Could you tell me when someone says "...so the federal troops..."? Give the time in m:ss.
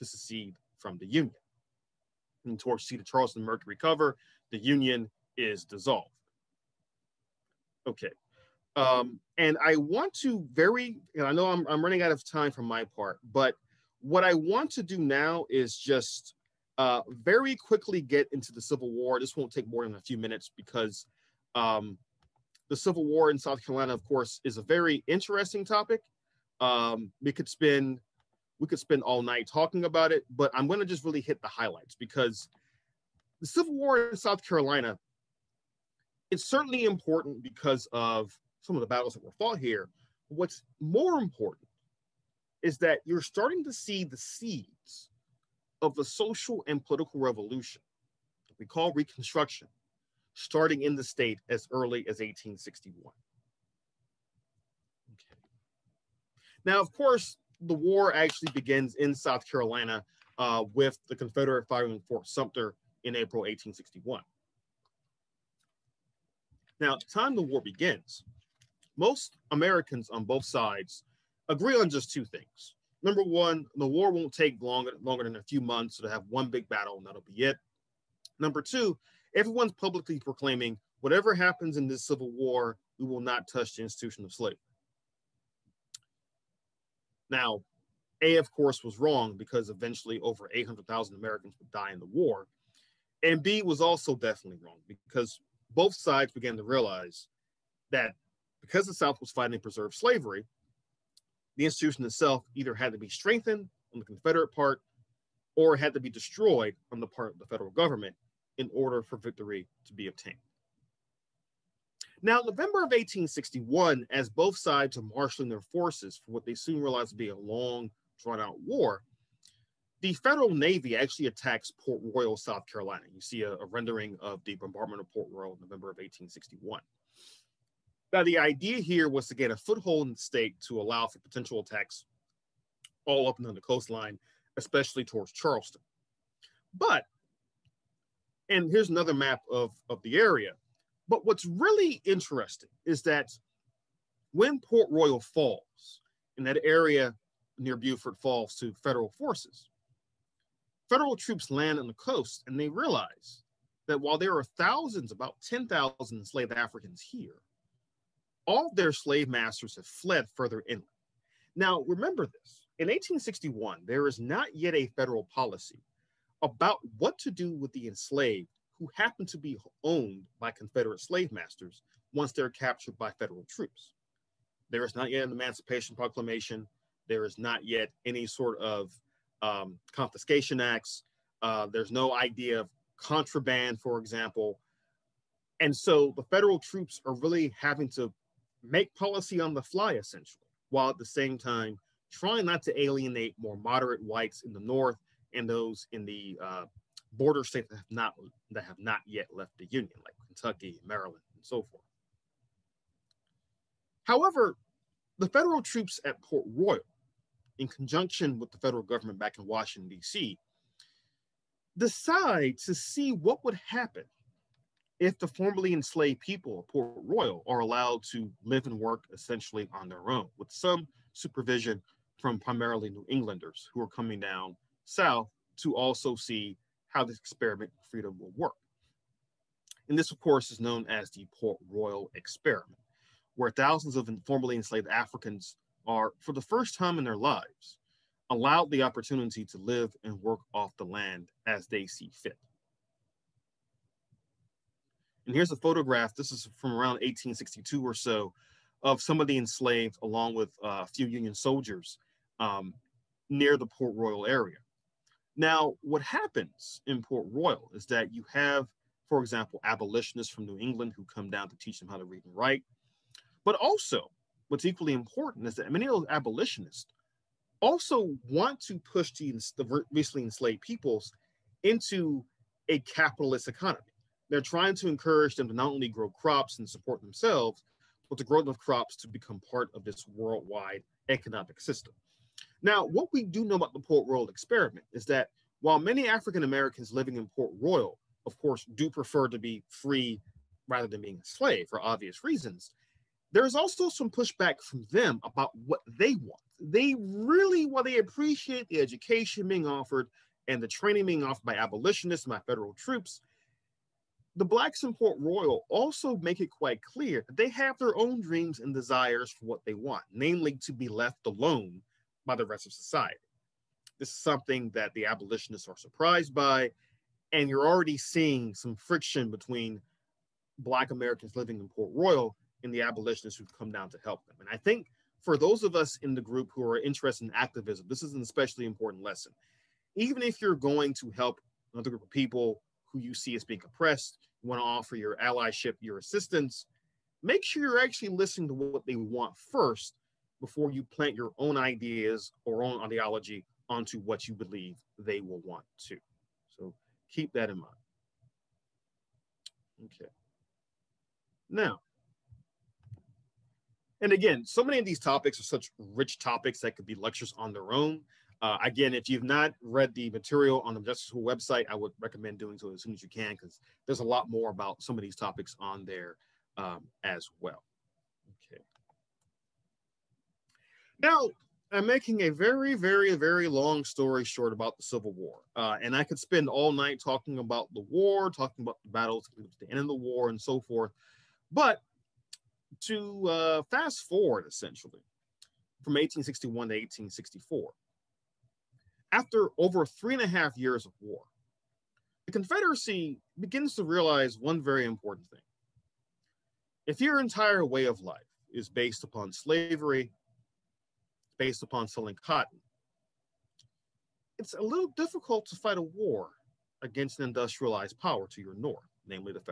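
3:05.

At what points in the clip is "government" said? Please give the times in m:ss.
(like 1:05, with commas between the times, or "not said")
1:47, 3:28.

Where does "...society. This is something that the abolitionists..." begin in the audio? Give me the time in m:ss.
5:12.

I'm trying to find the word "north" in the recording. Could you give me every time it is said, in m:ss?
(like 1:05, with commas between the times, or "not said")
3:14, 6:48.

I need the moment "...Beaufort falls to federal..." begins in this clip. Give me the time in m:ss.
2:27.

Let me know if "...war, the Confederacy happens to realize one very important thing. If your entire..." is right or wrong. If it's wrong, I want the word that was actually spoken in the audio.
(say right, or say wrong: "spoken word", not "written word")
wrong: "begins", not "happens".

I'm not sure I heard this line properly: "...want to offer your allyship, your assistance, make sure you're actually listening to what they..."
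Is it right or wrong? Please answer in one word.
right.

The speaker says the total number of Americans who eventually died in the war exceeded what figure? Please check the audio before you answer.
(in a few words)
800,000.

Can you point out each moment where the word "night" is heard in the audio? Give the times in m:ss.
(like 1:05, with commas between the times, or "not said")
0:29, 6:16.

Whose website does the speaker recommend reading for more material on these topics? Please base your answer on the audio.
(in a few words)
Justice School.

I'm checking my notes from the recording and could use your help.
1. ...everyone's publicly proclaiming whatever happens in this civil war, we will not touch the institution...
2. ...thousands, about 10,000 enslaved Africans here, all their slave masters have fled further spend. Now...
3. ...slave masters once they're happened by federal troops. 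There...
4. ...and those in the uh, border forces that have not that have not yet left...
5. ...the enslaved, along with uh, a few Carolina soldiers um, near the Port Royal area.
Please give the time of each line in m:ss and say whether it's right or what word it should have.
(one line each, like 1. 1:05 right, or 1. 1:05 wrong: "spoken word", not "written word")
1. 1:19 right
2. 2:34 wrong: "inland", not "spend"
3. 2:51 wrong: "captured", not "happened"
4. 3:15 wrong: "states", not "forces"
5. 4:09 wrong: "Union", not "Carolina".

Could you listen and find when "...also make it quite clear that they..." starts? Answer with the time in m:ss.
5:05.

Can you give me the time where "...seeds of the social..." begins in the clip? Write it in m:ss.
0:44.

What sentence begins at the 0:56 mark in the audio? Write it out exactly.
Now, of course, the war actually begins in South Carolina uh, with the Confederate firing Fort Sumter in April 1861.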